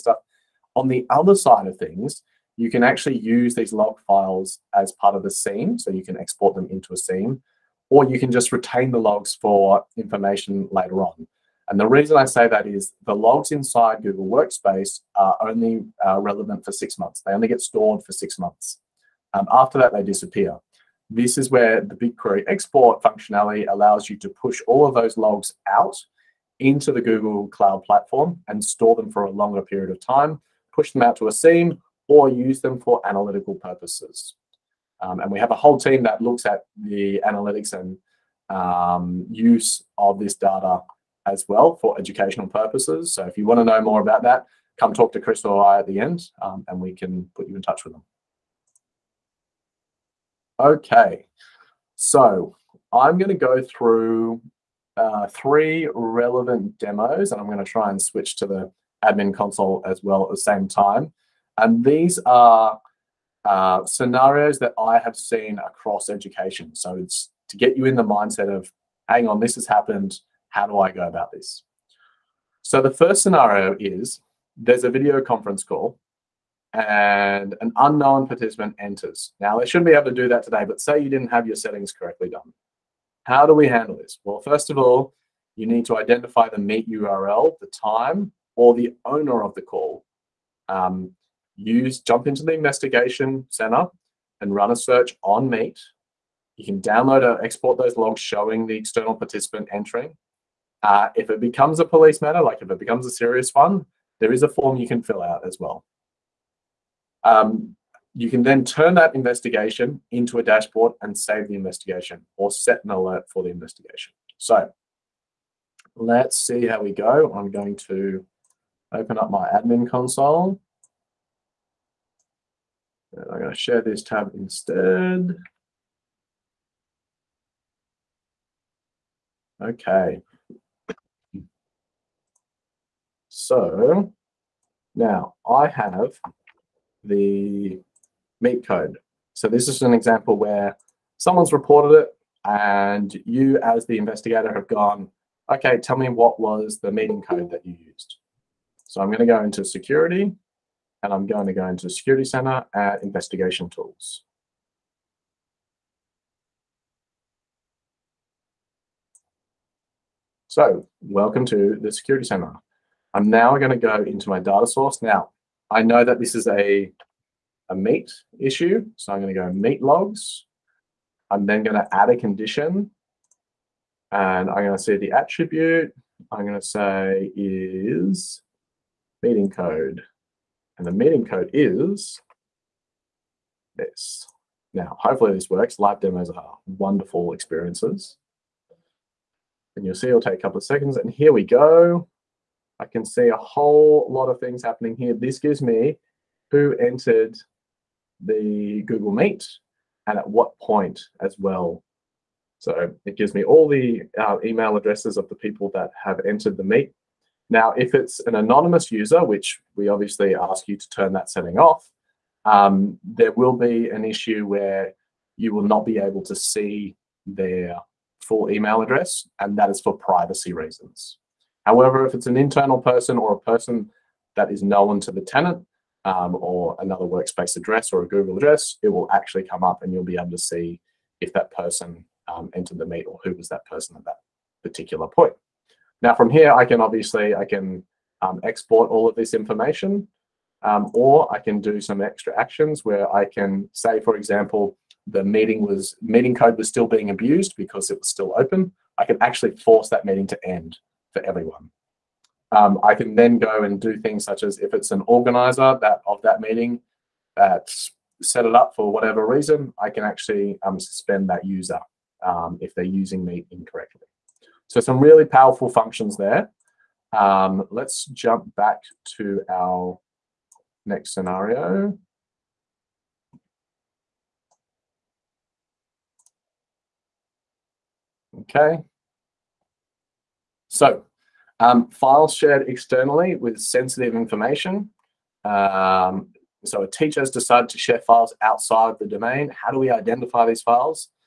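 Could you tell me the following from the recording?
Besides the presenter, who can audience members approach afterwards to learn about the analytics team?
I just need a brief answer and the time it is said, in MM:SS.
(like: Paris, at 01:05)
Chris, at 00:45.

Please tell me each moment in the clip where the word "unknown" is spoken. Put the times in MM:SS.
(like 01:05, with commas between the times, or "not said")
01:17.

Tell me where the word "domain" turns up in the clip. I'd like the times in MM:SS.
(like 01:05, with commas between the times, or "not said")
04:49.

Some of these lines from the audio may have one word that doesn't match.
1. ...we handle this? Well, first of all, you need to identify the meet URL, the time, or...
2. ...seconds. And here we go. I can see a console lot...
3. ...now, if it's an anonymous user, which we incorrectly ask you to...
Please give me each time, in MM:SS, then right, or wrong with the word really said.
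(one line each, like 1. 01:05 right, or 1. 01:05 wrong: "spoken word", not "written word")
1. 01:23 right
2. 03:10 wrong: "whole", not "console"
3. 03:27 wrong: "obviously", not "incorrectly".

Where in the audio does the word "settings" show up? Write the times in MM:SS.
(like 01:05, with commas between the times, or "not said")
01:21, 03:31.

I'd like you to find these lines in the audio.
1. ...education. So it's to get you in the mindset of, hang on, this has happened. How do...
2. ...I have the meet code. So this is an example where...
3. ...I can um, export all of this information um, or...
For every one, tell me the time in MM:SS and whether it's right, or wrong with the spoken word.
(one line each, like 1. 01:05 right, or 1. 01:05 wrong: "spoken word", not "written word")
1. 01:06 right
2. 02:15 right
3. 03:57 right.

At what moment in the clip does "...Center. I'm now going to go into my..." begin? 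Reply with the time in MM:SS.
02:42.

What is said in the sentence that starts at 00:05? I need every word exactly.
So you can export them into a SIEM, or you can just retain the logs for information later on.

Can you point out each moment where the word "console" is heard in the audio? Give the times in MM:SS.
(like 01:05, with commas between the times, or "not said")
00:59, 01:59.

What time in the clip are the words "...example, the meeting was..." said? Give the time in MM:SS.
04:04.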